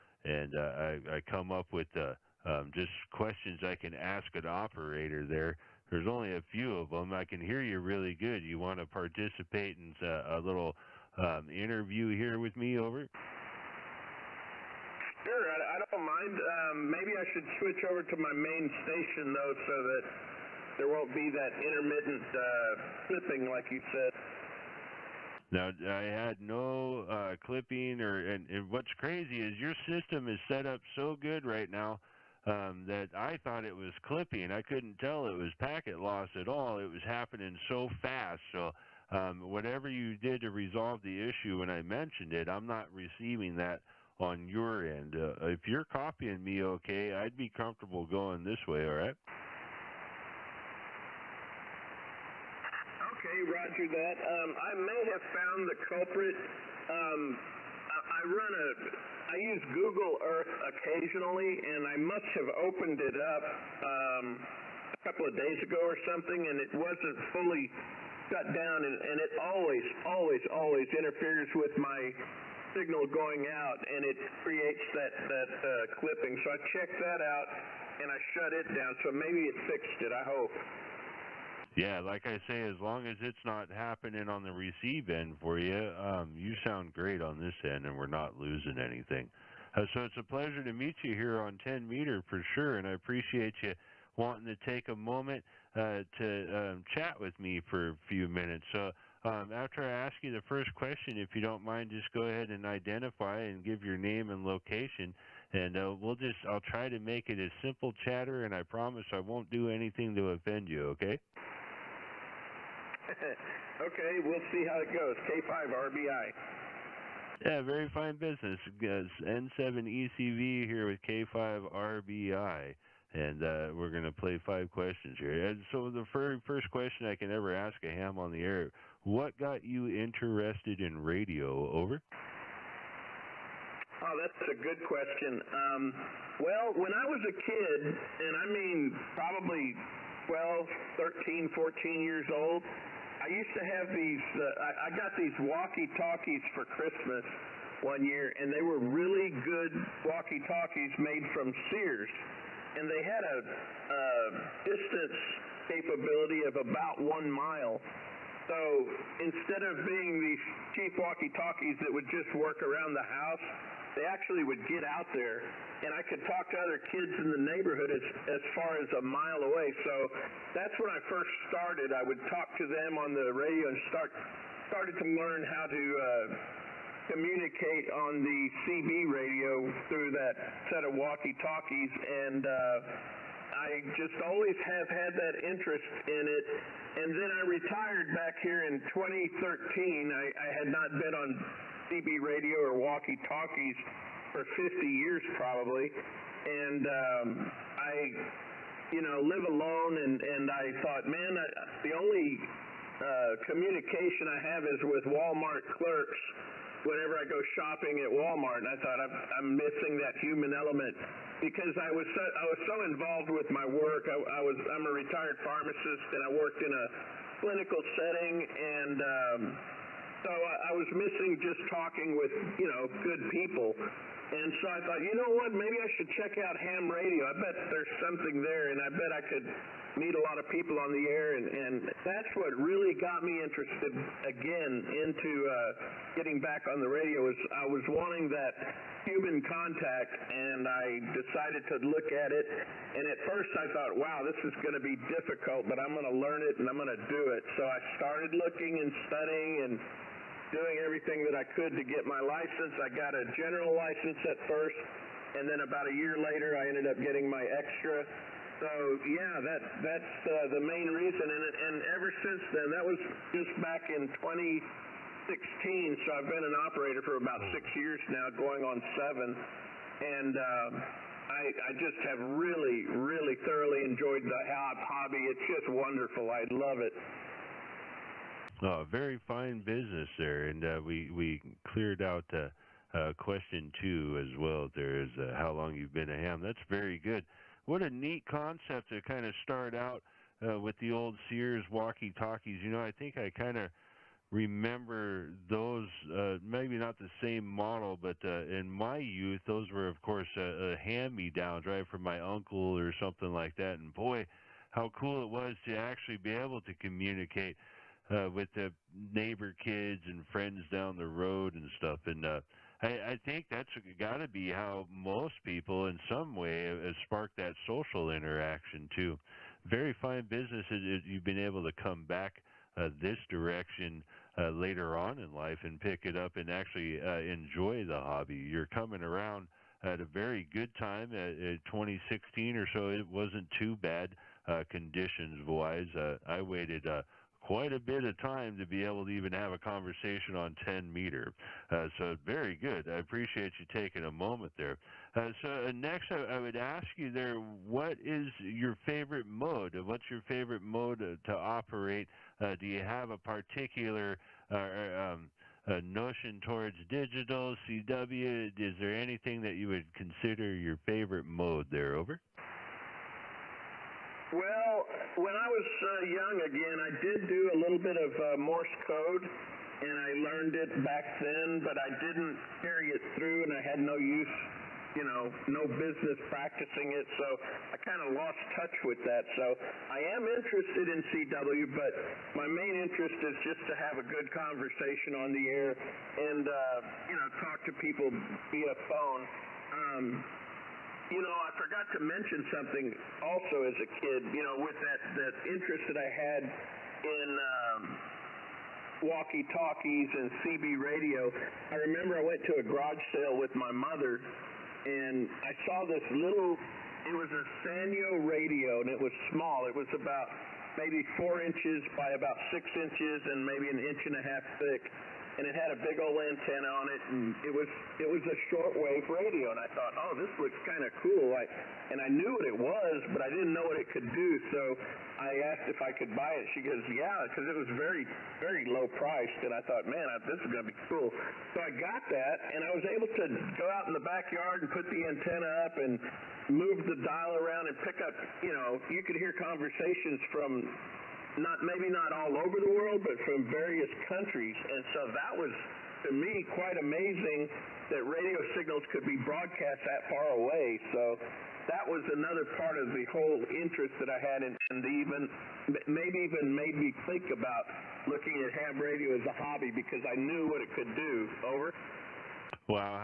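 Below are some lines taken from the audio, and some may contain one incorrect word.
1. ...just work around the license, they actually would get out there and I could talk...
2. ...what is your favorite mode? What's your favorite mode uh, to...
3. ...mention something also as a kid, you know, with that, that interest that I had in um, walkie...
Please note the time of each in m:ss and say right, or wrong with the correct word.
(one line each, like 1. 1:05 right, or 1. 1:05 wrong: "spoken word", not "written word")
1. 2:42 wrong: "house", not "license"
2. 5:47 right
3. 6:31 right.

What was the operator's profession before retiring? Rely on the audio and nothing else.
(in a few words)
Pharmacist.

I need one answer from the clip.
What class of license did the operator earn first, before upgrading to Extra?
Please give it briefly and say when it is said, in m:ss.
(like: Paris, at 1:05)
General, at 4:13.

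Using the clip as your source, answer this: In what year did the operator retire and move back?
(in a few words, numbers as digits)
2013.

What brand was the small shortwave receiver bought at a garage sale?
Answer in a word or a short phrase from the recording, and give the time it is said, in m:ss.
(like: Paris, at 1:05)
Sanyo, at 6:47.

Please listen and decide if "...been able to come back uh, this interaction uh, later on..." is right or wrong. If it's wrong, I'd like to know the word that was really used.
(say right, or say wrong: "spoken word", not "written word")
wrong: "direction", not "interaction".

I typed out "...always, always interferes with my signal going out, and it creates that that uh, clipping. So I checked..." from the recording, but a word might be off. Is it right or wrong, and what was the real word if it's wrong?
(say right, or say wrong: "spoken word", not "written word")
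right.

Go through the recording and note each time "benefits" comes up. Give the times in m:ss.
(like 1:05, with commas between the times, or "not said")
not said.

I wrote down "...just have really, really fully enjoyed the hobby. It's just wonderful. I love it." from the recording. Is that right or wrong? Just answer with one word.
wrong.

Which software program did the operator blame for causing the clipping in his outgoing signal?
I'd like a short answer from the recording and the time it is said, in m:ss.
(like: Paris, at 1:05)
Google Earth, at 0:59.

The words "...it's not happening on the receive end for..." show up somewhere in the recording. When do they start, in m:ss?
1:23.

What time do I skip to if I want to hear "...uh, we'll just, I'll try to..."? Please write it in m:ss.
1:45.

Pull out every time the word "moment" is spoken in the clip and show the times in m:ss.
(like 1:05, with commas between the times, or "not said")
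1:34, 5:44.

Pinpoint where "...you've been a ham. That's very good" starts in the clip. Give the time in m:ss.
4:45.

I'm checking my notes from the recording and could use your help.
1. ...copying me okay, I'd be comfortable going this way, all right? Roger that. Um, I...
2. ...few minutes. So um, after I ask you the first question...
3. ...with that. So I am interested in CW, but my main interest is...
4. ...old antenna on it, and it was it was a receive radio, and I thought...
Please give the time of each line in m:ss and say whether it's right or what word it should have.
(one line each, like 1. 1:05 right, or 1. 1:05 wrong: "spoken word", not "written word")
1. 0:45 right
2. 1:38 right
3. 6:18 right
4. 6:56 wrong: "shortwave", not "receive".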